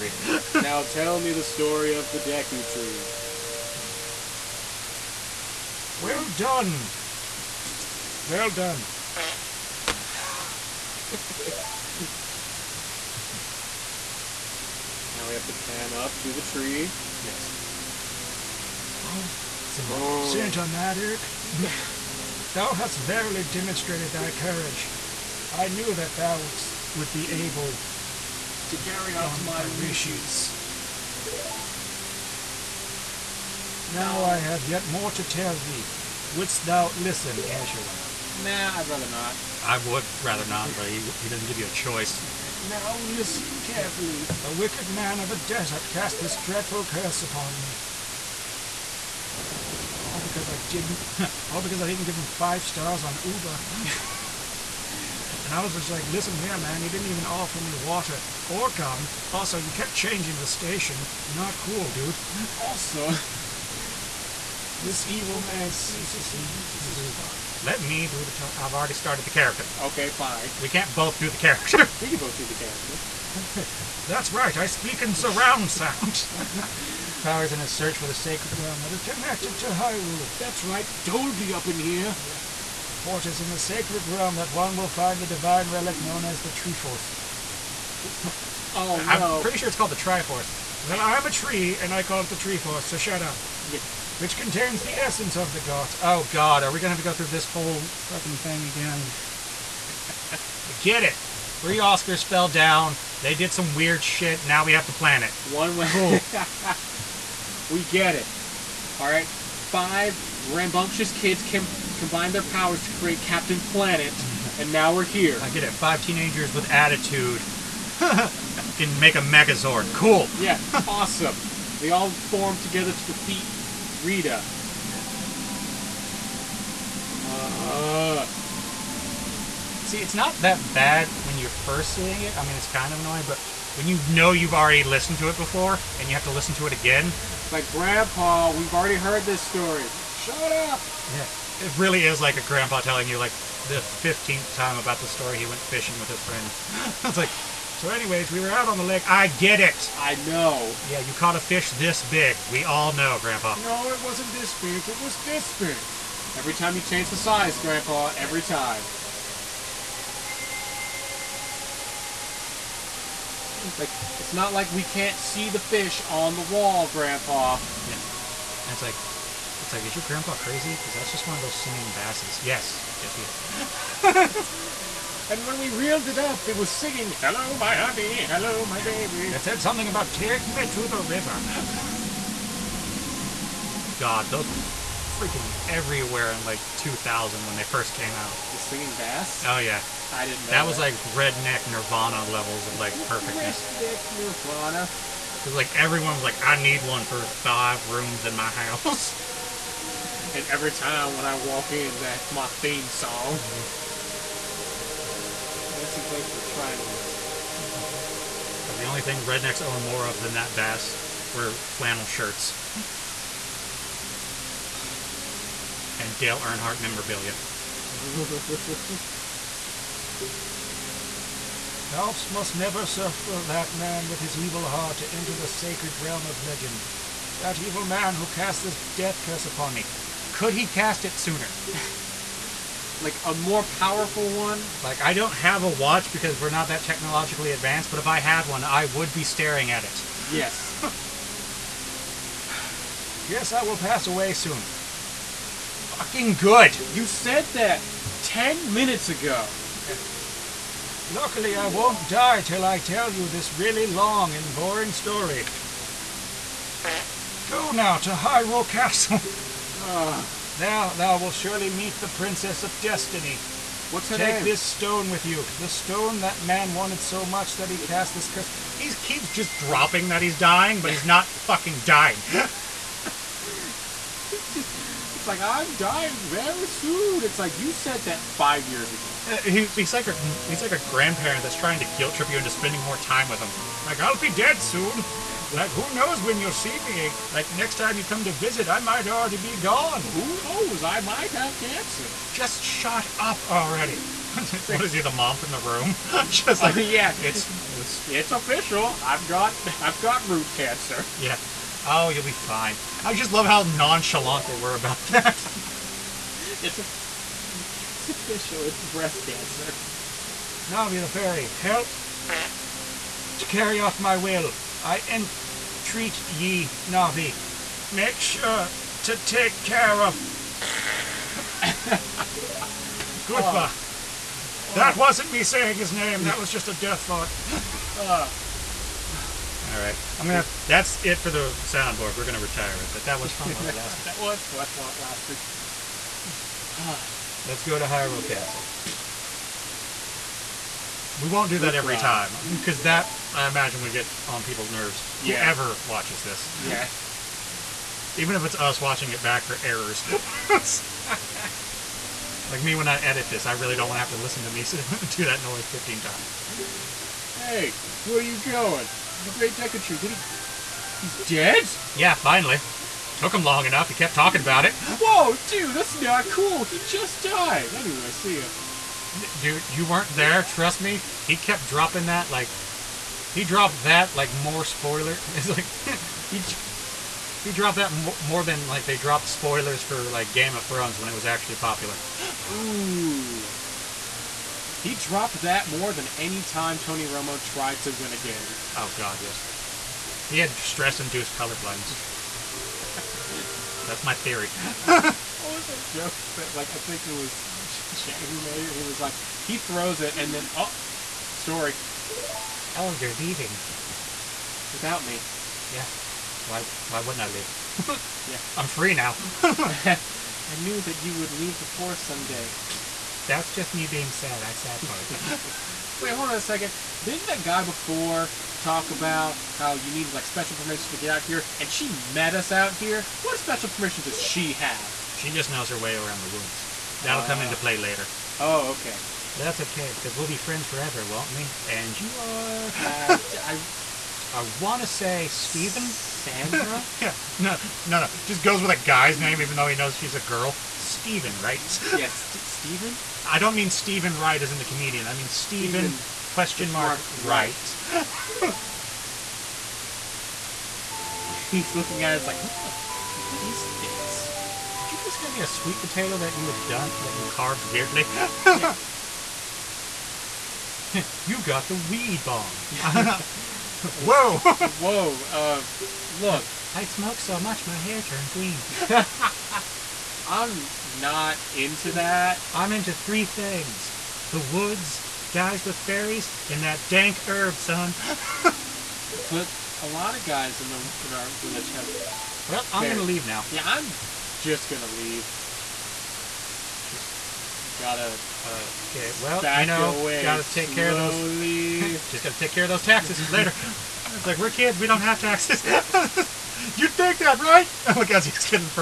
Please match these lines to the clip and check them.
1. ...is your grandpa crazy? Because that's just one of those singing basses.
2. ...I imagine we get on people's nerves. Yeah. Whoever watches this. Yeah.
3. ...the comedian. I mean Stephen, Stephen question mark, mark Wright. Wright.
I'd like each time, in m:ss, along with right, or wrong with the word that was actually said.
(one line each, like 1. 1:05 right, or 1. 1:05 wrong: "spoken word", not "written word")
1. 2:49 right
2. 5:43 right
3. 7:24 right.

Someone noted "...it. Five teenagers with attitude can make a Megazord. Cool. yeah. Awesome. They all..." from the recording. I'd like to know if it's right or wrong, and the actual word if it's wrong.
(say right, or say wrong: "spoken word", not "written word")
right.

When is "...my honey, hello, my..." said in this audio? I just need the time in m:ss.
2:57.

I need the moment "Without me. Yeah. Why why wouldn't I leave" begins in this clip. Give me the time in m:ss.
6:44.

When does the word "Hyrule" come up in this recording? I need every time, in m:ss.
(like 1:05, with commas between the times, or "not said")
1:19, 4:18, 5:37.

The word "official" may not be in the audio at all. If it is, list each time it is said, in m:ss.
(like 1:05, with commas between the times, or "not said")
4:58, 5:08.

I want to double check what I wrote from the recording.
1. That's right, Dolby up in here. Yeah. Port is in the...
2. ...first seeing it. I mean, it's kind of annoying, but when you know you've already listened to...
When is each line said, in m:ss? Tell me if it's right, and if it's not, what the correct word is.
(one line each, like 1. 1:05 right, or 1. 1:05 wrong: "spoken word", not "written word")
1. 1:20 right
2. 2:11 right.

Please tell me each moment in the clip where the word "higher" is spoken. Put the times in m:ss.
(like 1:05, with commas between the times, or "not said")
not said.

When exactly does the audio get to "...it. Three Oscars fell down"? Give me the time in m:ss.
1:41.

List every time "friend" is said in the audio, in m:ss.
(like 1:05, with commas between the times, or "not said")
2:26, 7:10.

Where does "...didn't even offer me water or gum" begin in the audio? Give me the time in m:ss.
0:56.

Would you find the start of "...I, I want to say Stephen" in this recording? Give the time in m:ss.
7:13.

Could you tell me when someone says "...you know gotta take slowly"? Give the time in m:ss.
8:09.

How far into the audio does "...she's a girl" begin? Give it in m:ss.
7:19.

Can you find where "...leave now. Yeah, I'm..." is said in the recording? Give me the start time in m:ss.
8:03.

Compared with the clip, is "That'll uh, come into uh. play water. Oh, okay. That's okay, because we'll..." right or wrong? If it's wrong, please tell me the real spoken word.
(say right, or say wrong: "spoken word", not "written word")
wrong: "later", not "water".